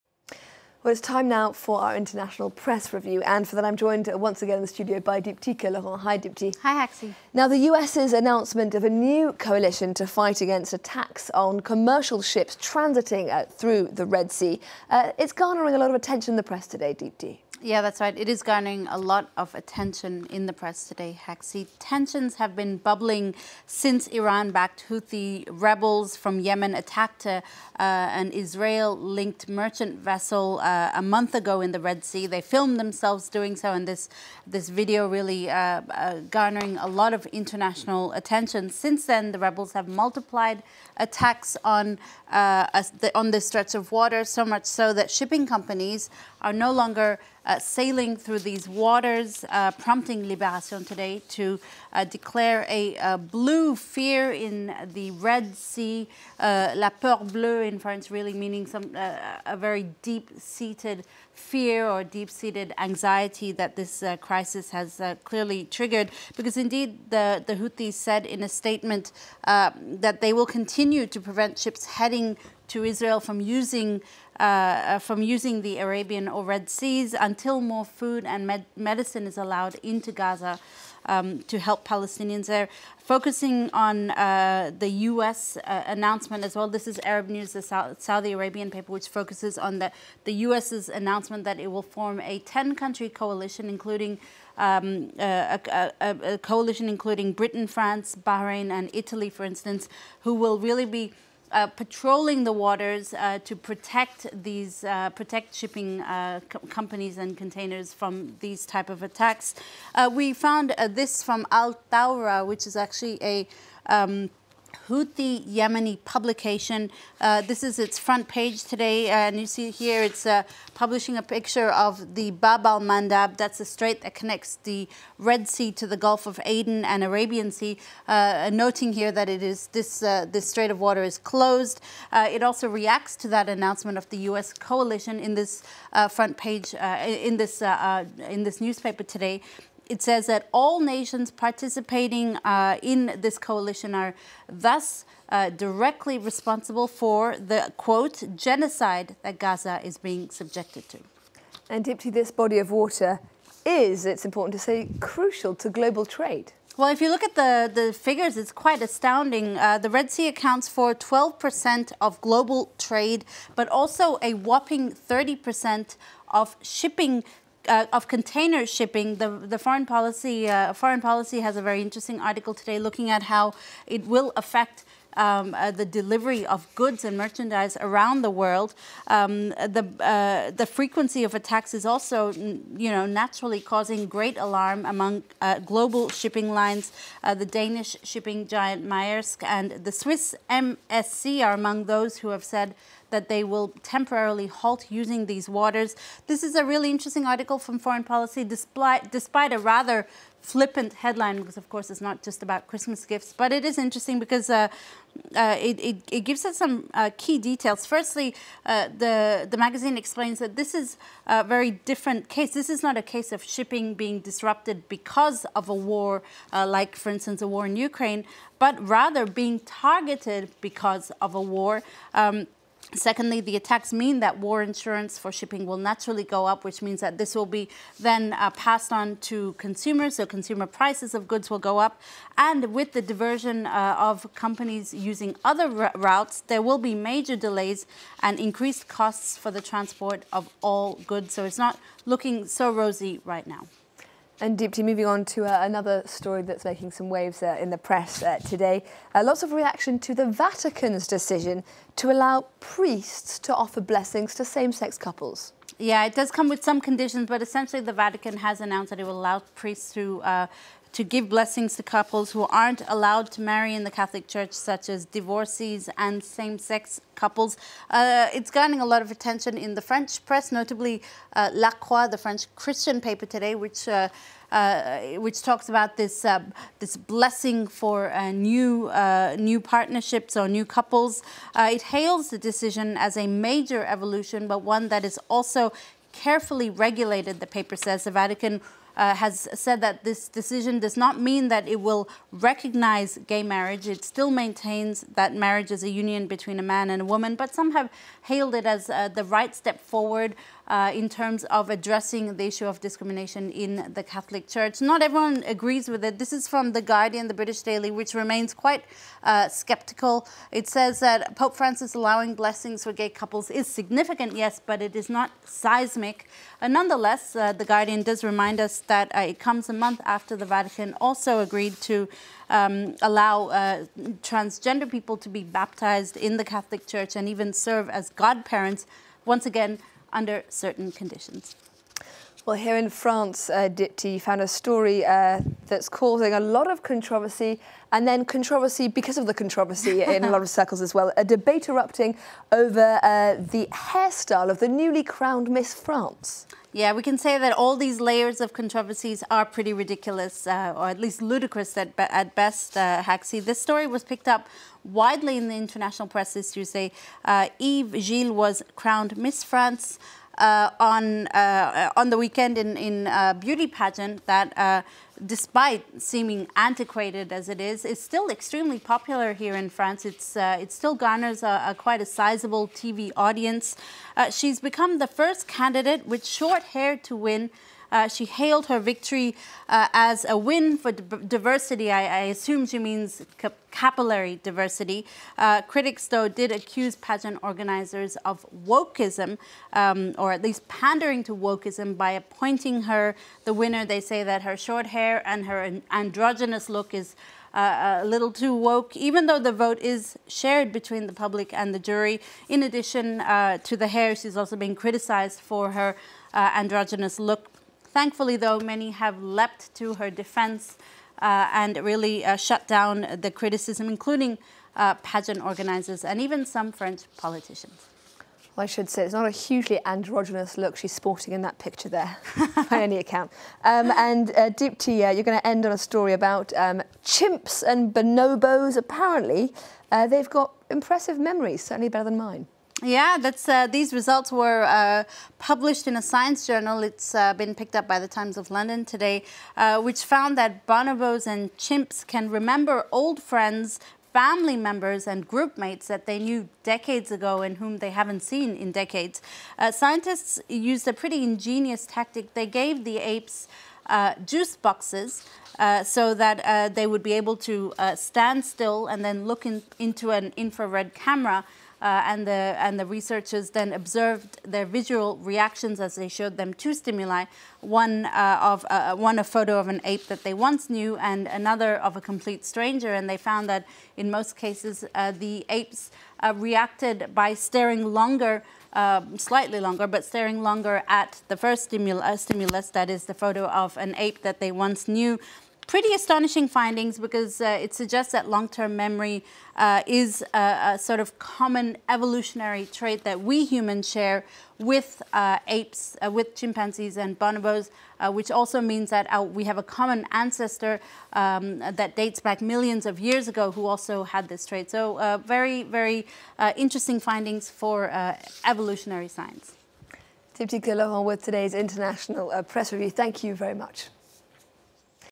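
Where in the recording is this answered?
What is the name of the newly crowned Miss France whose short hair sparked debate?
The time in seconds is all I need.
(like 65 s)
357 s.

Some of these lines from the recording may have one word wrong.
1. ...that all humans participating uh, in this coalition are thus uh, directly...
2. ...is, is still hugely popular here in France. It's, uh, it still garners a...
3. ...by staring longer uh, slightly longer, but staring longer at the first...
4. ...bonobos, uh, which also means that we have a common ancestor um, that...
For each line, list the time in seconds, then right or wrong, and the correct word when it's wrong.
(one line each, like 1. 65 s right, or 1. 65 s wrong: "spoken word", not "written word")
1. 140 s wrong: "nations", not "humans"
2. 367 s wrong: "extremely", not "hugely"
3. 477 s right
4. 497 s right.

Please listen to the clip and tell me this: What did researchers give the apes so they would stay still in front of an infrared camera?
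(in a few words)
juice boxes.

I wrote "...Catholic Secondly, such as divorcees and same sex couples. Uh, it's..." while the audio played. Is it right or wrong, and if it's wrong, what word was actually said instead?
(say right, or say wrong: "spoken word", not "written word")
wrong: "Church", not "Secondly".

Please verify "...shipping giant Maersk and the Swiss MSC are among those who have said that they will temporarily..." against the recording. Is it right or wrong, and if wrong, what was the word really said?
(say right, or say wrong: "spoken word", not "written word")
right.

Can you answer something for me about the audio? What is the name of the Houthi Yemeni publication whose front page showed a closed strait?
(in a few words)
Al Thawra.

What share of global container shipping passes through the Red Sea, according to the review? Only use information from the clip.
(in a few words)
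30%.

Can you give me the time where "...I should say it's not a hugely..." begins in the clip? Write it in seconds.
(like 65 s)
418 s.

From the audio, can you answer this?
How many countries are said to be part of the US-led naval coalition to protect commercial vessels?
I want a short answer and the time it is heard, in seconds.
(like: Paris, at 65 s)
10, at 92 s.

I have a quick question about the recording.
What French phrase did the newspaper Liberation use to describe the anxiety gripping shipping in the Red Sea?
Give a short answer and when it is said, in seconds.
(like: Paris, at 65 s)
la peur bleue, at 56 s.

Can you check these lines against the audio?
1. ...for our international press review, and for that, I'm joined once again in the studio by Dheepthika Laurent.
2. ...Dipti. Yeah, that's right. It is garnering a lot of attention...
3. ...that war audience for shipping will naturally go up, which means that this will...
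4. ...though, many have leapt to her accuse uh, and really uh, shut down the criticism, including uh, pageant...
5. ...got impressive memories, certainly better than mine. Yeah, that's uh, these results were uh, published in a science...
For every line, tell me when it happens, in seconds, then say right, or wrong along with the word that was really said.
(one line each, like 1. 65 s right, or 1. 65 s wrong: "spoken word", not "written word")
1. 1 s right
2. 16 s right
3. 224 s wrong: "insurance", not "audience"
4. 408 s wrong: "defense", not "accuse"
5. 430 s right.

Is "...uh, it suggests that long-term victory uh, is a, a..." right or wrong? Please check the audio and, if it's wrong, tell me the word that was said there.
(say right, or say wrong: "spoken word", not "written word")
wrong: "memory", not "victory".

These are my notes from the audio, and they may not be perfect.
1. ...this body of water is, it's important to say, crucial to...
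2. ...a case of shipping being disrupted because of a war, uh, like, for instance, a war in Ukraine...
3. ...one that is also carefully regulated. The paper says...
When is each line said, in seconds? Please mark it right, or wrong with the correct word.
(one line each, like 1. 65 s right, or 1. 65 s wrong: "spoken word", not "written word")
1. 152 s right
2. 212 s right
3. 284 s right.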